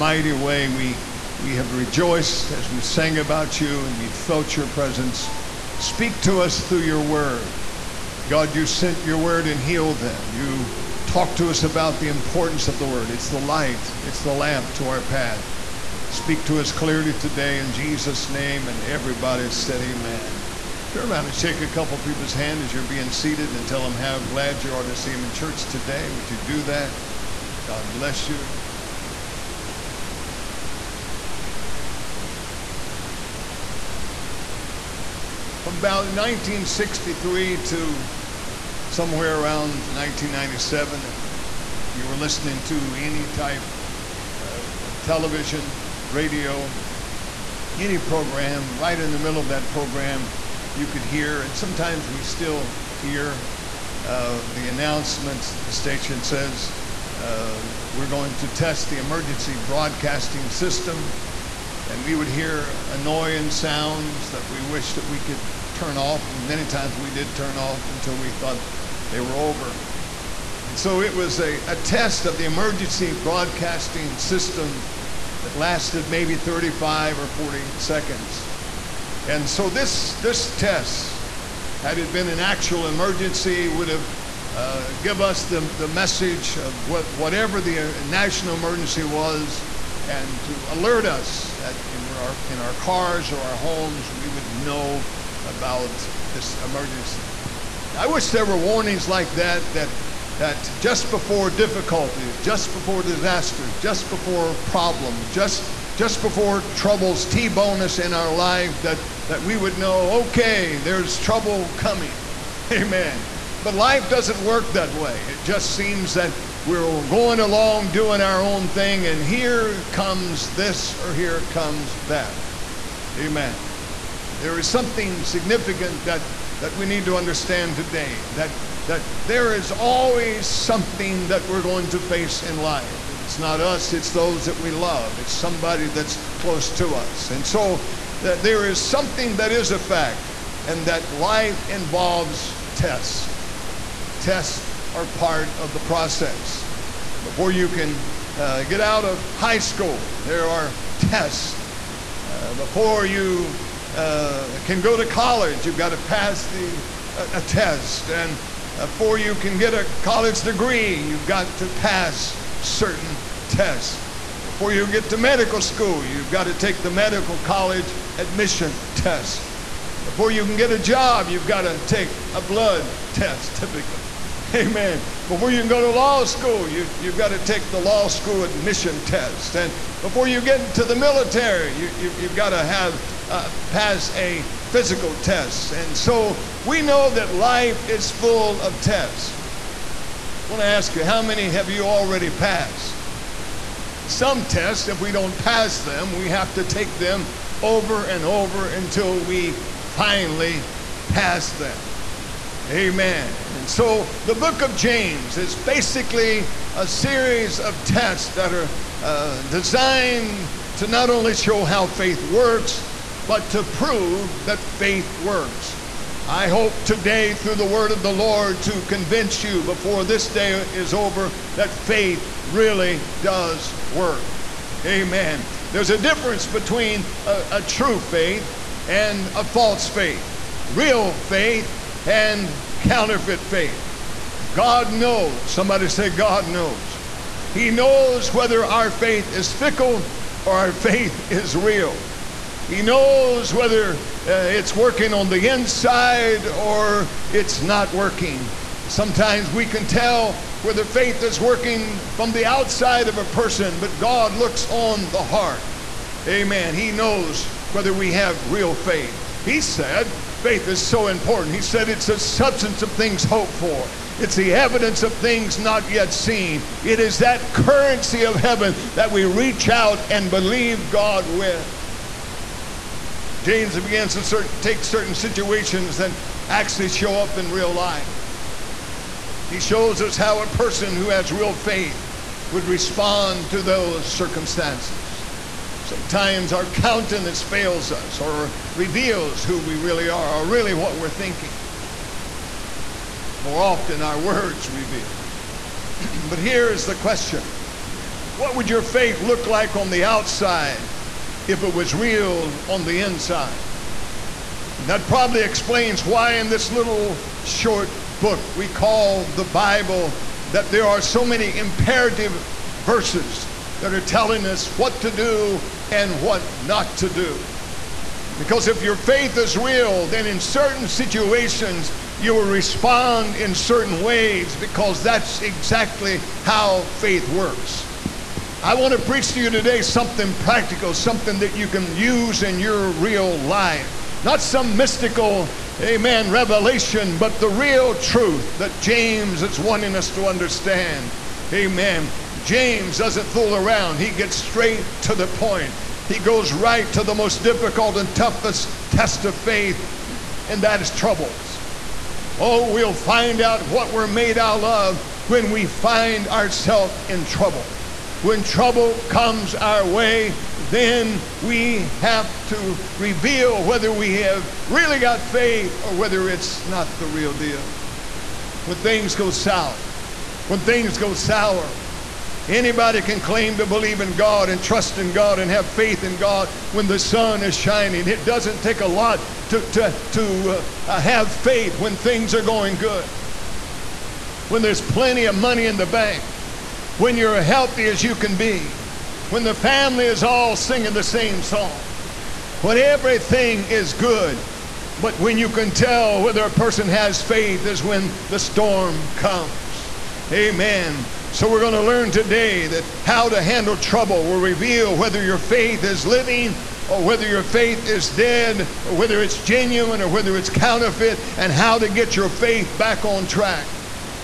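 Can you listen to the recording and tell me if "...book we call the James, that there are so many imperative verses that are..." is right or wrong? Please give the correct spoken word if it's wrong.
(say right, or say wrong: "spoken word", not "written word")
wrong: "Bible", not "James".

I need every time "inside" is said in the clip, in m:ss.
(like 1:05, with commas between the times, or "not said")
4:05, 5:03.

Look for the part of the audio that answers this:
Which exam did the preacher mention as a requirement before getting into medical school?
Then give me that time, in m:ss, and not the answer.
2:46.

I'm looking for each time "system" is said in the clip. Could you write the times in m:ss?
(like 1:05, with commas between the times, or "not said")
1:00, 1:14.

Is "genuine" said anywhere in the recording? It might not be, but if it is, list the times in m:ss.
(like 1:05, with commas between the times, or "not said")
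6:49.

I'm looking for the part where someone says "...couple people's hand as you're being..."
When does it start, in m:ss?
0:21.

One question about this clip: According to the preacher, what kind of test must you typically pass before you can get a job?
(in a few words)
blood test.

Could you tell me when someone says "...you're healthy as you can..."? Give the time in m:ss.
6:27.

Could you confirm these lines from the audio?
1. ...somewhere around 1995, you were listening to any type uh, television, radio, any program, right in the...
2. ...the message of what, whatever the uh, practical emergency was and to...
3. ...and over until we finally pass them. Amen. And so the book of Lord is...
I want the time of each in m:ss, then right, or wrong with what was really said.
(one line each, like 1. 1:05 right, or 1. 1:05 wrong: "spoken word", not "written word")
1. 0:38 wrong: "1997", not "1995"
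2. 1:25 wrong: "national", not "practical"
3. 3:18 wrong: "James", not "Lord".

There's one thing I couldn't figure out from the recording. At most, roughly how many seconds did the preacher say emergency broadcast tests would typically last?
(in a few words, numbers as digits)
40.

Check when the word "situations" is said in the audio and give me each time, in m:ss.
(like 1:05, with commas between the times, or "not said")
4:35, 5:20.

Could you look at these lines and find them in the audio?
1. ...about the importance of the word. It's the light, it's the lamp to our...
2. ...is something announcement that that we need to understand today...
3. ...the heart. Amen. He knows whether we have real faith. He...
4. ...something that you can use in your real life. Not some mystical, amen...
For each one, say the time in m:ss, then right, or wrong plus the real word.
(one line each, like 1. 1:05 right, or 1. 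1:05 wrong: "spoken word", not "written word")
1. 0:11 right
2. 2:04 wrong: "significant", not "announcement"
3. 4:15 right
4. 5:30 right.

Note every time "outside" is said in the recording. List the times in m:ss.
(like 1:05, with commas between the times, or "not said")
4:12, 5:00.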